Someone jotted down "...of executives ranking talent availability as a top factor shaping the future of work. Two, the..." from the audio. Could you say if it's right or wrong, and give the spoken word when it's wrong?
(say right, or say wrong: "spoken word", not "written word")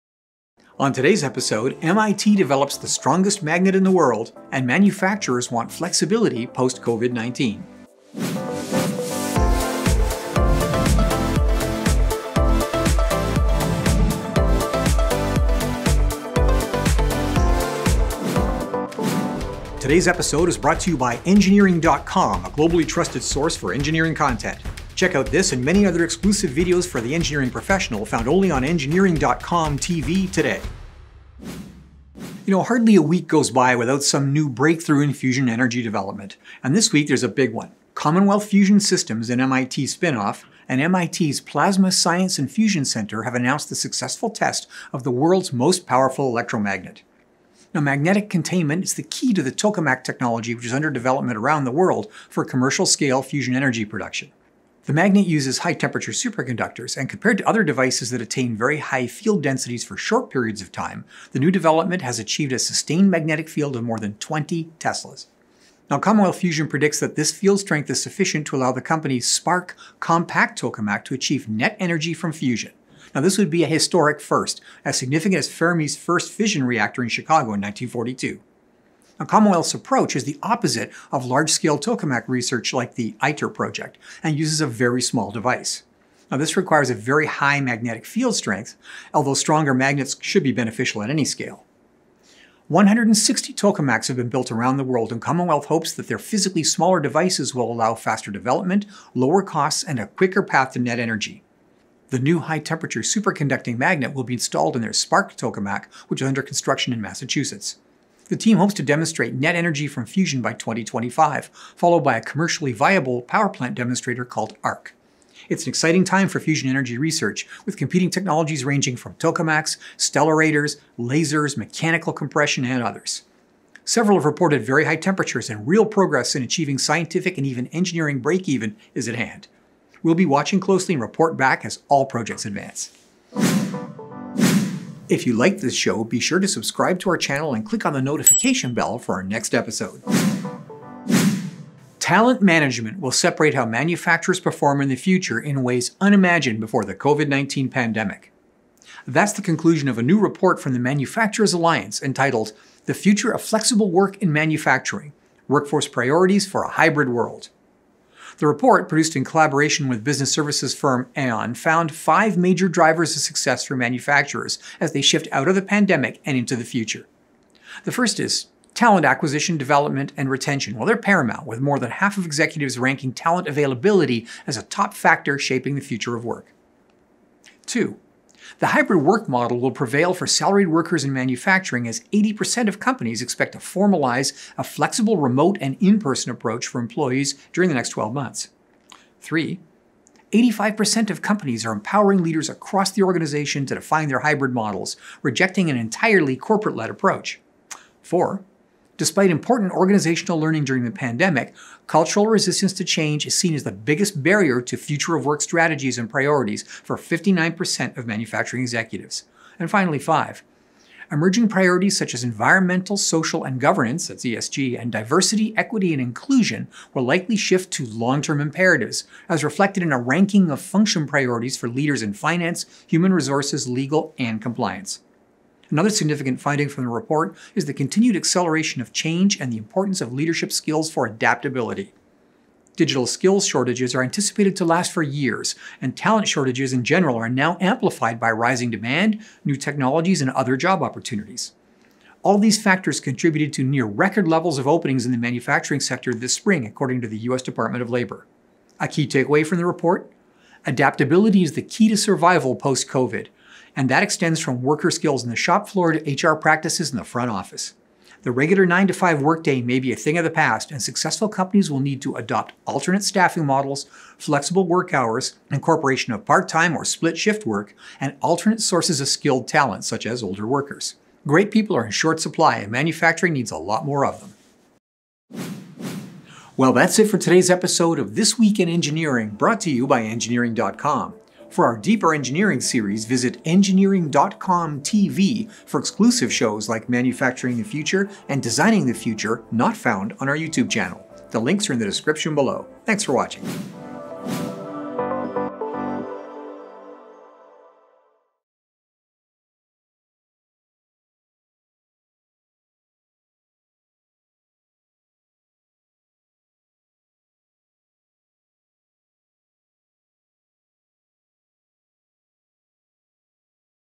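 right.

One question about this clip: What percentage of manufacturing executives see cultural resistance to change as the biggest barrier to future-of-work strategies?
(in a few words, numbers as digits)
59%.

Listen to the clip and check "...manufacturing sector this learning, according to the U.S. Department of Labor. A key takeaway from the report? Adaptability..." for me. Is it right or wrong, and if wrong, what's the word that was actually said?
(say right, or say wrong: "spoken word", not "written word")
wrong: "spring", not "learning".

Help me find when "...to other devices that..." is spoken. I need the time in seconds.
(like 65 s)
57 s.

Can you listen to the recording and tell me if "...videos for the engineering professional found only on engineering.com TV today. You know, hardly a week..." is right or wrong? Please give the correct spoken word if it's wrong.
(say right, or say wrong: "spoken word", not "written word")
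right.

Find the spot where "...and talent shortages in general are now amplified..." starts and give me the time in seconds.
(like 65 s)
235 s.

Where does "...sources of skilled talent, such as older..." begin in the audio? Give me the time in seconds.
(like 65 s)
268 s.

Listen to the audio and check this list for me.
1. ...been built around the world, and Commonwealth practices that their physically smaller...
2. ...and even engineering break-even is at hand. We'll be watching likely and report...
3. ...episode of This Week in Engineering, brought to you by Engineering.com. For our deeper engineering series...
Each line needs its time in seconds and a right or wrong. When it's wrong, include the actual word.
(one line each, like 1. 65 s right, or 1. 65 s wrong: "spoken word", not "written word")
1. 94 s wrong: "hopes", not "practices"
2. 127 s wrong: "closely", not "likely"
3. 277 s right.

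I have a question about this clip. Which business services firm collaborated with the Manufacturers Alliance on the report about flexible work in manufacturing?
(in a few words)
Aon.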